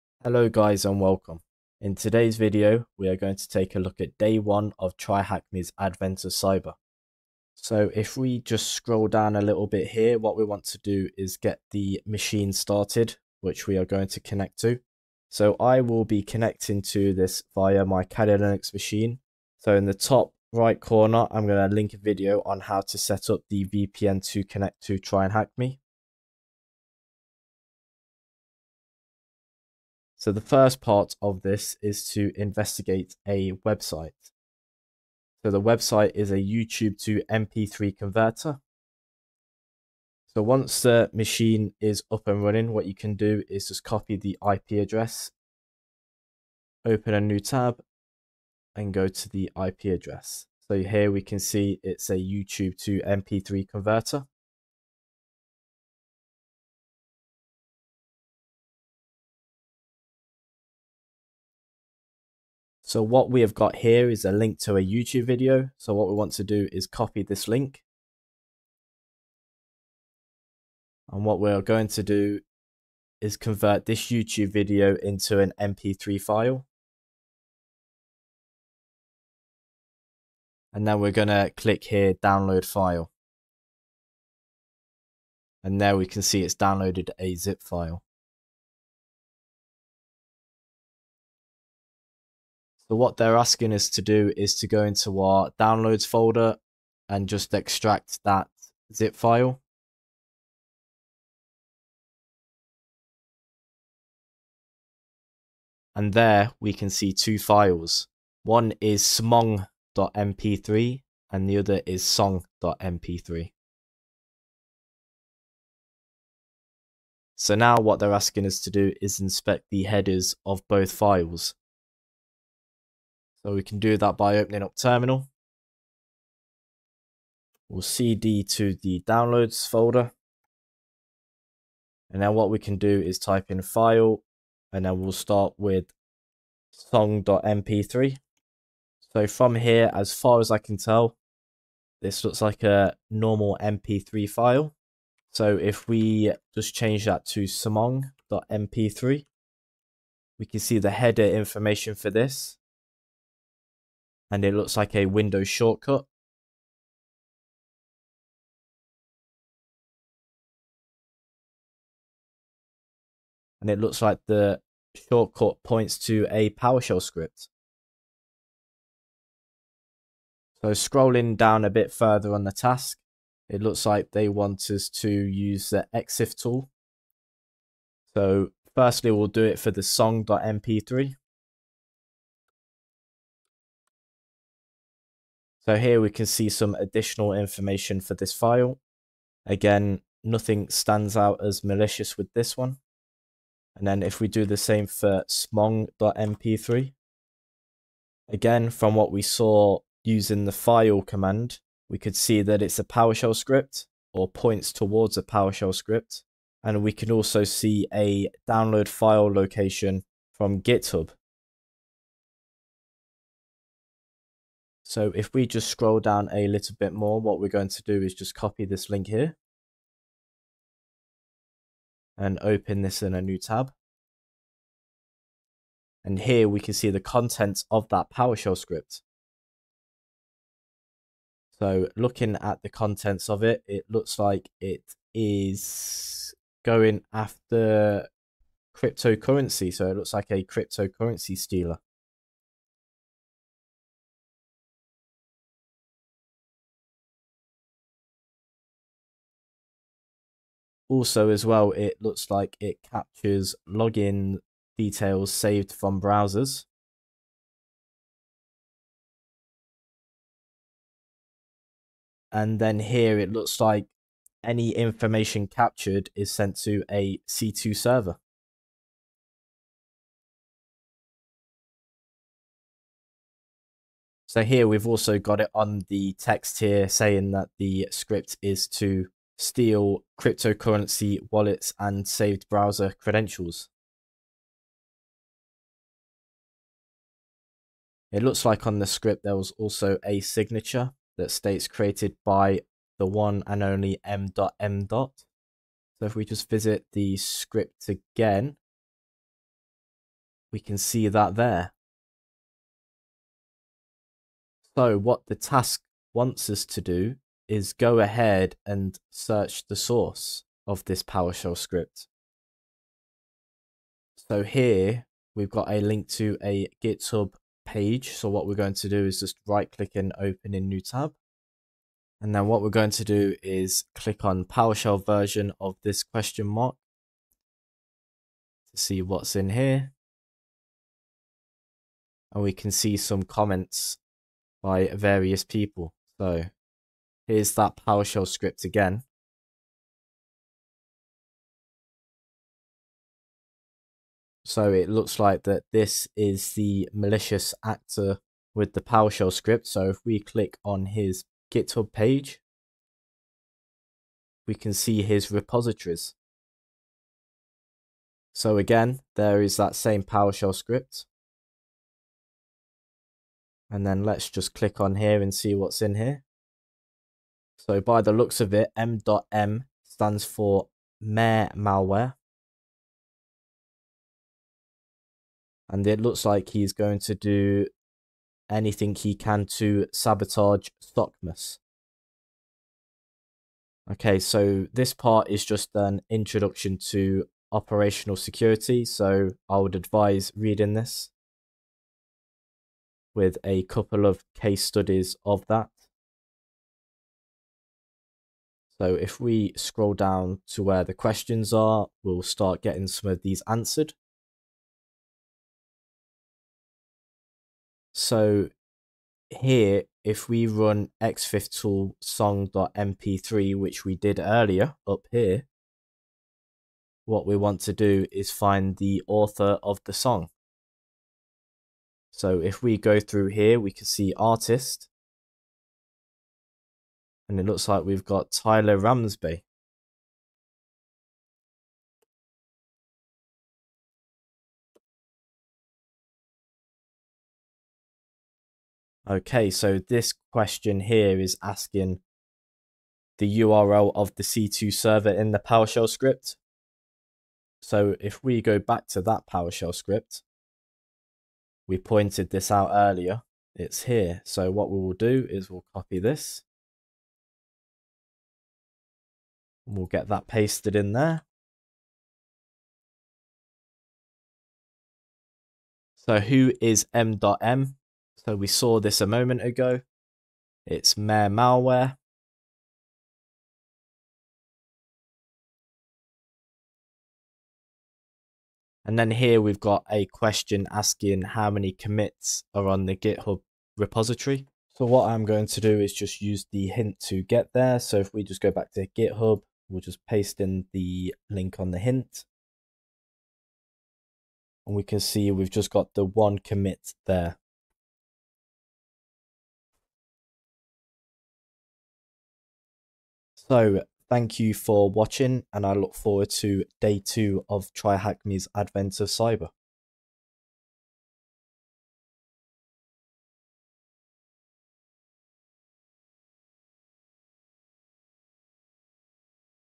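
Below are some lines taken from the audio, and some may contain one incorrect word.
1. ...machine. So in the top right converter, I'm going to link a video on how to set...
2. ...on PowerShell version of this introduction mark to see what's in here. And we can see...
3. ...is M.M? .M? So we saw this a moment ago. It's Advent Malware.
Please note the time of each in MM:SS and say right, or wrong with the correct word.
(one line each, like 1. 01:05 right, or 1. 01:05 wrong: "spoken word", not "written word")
1. 00:18 wrong: "corner", not "converter"
2. 05:24 wrong: "question", not "introduction"
3. 07:46 wrong: "Mayor", not "Advent".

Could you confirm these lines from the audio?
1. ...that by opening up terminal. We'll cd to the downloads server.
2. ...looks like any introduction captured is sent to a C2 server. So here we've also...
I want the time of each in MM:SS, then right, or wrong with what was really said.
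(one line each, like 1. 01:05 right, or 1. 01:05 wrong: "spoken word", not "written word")
1. 02:03 wrong: "folder", not "server"
2. 04:23 wrong: "information", not "introduction".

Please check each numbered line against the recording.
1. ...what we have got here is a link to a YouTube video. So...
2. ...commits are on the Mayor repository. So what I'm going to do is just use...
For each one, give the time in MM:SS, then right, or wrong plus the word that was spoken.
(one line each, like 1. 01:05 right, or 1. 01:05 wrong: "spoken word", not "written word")
1. 01:03 right
2. 08:01 wrong: "GitHub", not "Mayor".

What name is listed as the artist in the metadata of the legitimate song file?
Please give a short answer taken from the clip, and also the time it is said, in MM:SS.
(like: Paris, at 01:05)
Tyler Ramsbey, at 07:08.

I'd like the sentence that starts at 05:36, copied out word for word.
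So Here's that PowerShell script again.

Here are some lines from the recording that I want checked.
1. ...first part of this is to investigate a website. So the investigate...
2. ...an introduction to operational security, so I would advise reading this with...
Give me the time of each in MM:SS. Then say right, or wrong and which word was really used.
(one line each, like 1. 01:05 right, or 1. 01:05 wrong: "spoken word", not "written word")
1. 00:30 wrong: "website", not "investigate"
2. 06:25 right.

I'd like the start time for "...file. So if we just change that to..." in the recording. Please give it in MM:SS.
02:24.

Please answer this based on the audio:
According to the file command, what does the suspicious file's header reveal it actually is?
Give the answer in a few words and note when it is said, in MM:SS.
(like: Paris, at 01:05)
Windows shortcut, at 02:35.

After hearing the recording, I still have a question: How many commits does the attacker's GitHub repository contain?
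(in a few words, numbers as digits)
1.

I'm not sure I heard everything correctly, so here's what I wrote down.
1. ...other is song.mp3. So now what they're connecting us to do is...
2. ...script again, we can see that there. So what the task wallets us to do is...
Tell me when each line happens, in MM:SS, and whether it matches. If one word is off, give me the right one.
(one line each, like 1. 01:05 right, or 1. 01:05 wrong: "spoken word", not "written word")
1. 01:51 wrong: "asking", not "connecting"
2. 04:57 wrong: "wants", not "wallets".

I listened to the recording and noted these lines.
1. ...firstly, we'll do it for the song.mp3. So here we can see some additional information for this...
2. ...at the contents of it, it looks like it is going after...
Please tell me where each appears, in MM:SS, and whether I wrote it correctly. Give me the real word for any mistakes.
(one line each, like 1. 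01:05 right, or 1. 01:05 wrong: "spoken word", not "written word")
1. 02:58 right
2. 03:52 right.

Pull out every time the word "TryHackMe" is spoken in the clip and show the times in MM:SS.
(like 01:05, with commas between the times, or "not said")
00:04, 08:27.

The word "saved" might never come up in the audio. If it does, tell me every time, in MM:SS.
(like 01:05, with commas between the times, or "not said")
04:15, 04:42.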